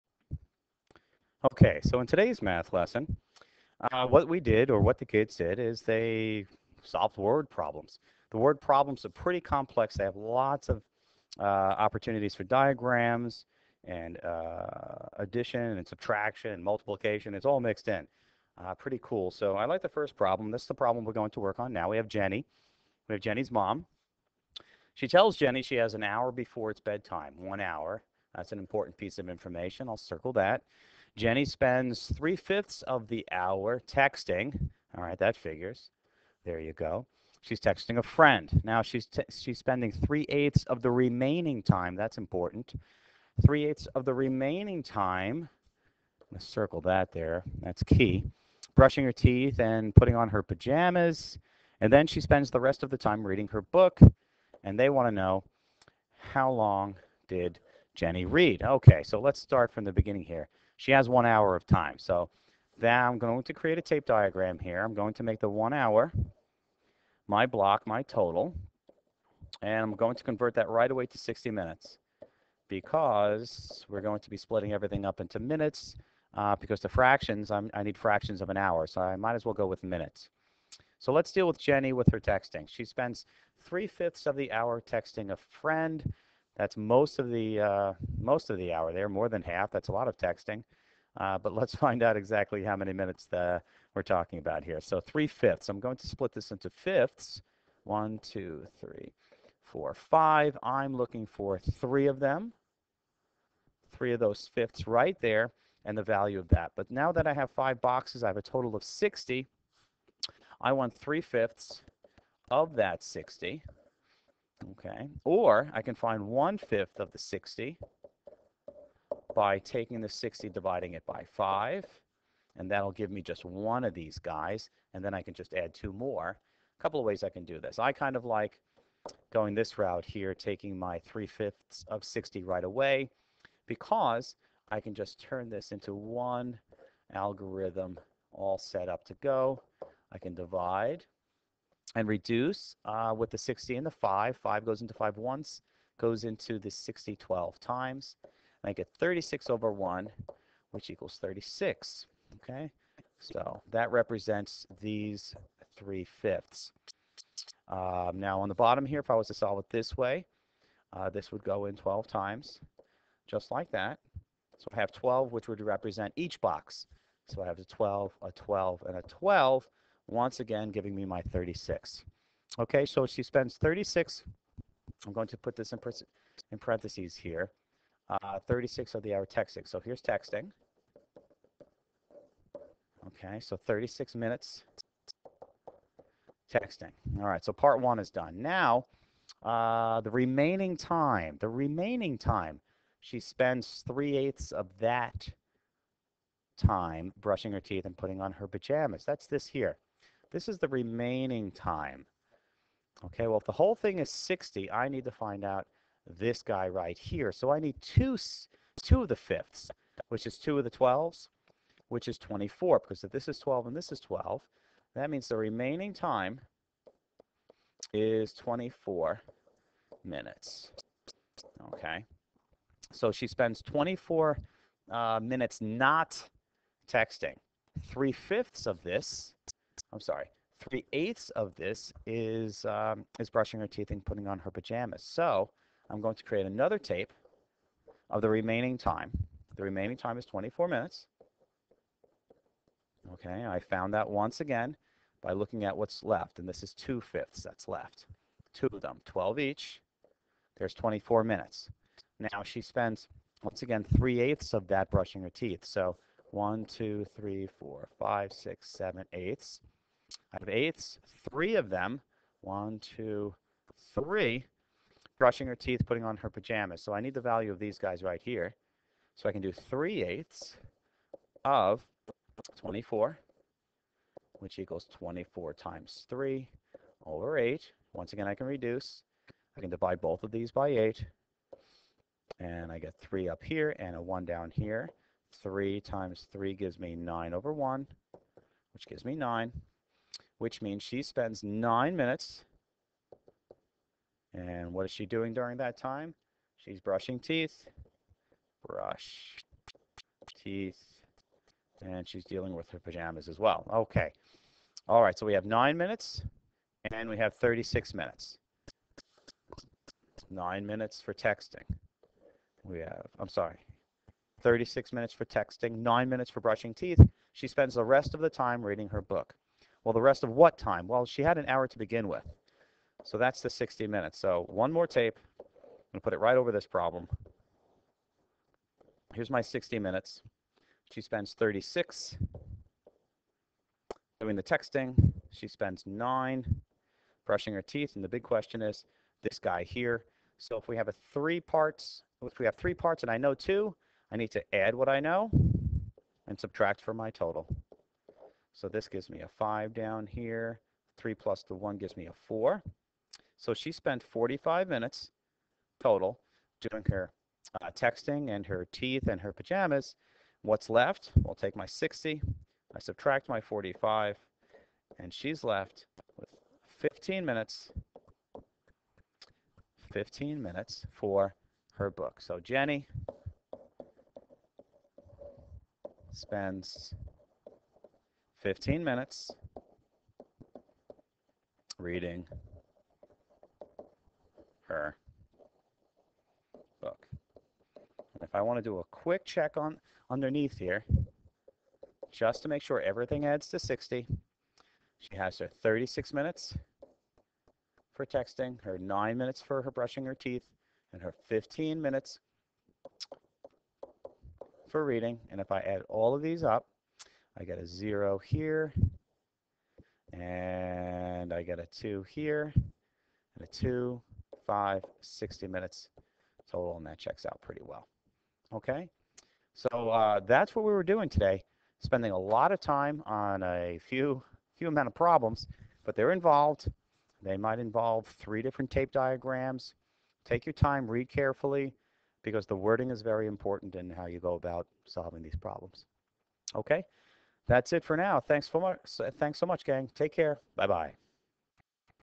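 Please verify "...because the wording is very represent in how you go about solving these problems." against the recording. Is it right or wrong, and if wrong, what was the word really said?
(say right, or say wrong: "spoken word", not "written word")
wrong: "important", not "represent".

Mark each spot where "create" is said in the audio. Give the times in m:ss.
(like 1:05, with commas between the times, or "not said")
1:03, 3:56.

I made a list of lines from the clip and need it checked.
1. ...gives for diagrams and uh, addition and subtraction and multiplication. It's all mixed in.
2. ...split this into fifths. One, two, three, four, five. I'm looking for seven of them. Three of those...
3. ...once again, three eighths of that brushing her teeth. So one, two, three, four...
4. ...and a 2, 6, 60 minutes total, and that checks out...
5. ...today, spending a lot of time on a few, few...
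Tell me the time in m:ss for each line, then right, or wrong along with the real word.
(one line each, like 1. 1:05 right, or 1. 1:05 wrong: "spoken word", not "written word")
1. 0:11 wrong: "opportunities", not "gives"
2. 1:36 wrong: "three", not "seven"
3. 4:13 right
4. 6:52 wrong: "5", not "6"
5. 7:01 right.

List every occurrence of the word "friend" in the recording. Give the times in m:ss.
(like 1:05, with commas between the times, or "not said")
0:38, 1:25.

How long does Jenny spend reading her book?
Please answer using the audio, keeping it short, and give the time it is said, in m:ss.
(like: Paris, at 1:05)
15 minutes, at 6:09.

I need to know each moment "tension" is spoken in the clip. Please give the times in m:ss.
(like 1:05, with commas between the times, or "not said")
not said.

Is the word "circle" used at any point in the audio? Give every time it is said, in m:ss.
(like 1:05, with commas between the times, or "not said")
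0:29, 0:46.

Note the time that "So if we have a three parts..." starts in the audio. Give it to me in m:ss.
5:40.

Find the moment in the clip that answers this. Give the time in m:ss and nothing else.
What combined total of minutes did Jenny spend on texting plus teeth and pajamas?
5:54.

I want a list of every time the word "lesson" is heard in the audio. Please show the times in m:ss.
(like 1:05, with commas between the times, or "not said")
0:02.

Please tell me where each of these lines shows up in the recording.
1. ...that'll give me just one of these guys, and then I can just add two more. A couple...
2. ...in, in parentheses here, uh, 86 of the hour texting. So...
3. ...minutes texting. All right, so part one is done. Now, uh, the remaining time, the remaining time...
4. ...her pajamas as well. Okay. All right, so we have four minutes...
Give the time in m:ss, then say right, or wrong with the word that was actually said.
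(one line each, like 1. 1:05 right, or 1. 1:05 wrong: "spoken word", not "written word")
1. 2:02 right
2. 2:55 wrong: "36", not "86"
3. 3:04 right
4. 5:02 wrong: "nine", not "four".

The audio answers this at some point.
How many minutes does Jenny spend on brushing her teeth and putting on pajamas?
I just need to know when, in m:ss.
4:50.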